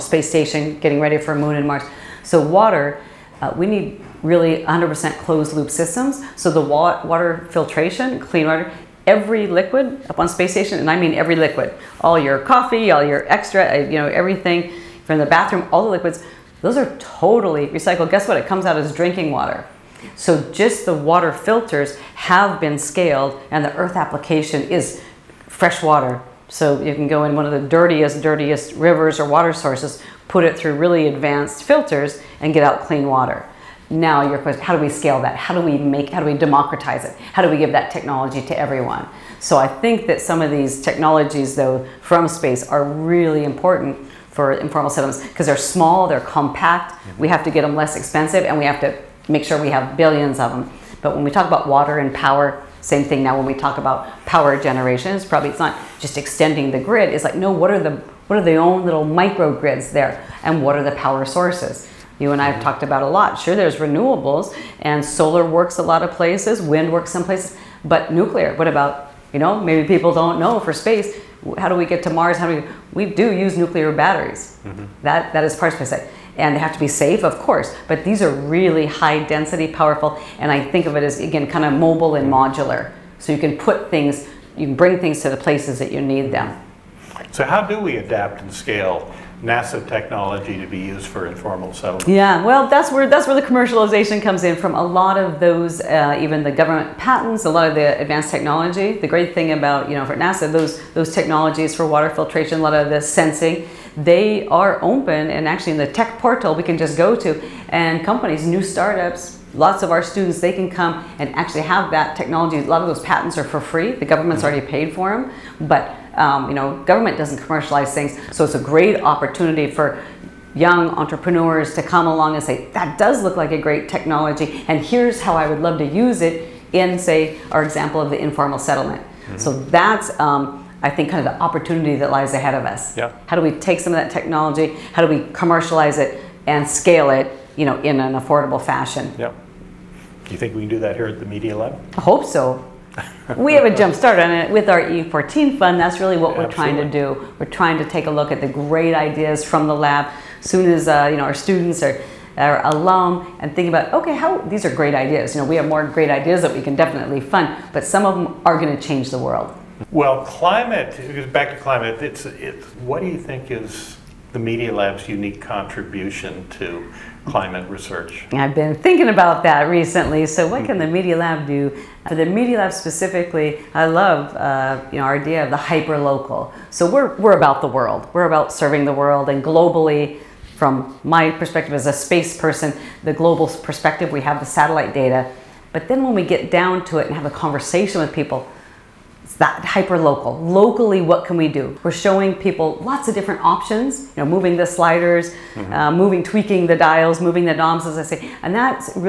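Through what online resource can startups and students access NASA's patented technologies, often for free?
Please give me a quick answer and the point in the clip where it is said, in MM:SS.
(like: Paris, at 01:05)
Tech portal, at 01:45.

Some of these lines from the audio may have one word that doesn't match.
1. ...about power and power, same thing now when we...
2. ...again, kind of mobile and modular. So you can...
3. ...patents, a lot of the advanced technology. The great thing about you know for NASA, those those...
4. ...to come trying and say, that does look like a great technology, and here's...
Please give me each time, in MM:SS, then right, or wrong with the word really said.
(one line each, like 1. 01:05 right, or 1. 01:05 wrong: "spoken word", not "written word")
1. 00:51 wrong: "water", not "power"
2. 01:21 right
3. 01:36 right
4. 02:01 wrong: "along", not "trying".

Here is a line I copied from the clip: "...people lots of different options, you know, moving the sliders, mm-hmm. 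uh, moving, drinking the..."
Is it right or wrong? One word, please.
wrong.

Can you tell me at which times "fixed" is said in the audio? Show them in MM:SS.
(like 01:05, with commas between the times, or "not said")
not said.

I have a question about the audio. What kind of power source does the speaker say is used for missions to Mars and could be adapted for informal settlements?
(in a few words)
Nuclear batteries.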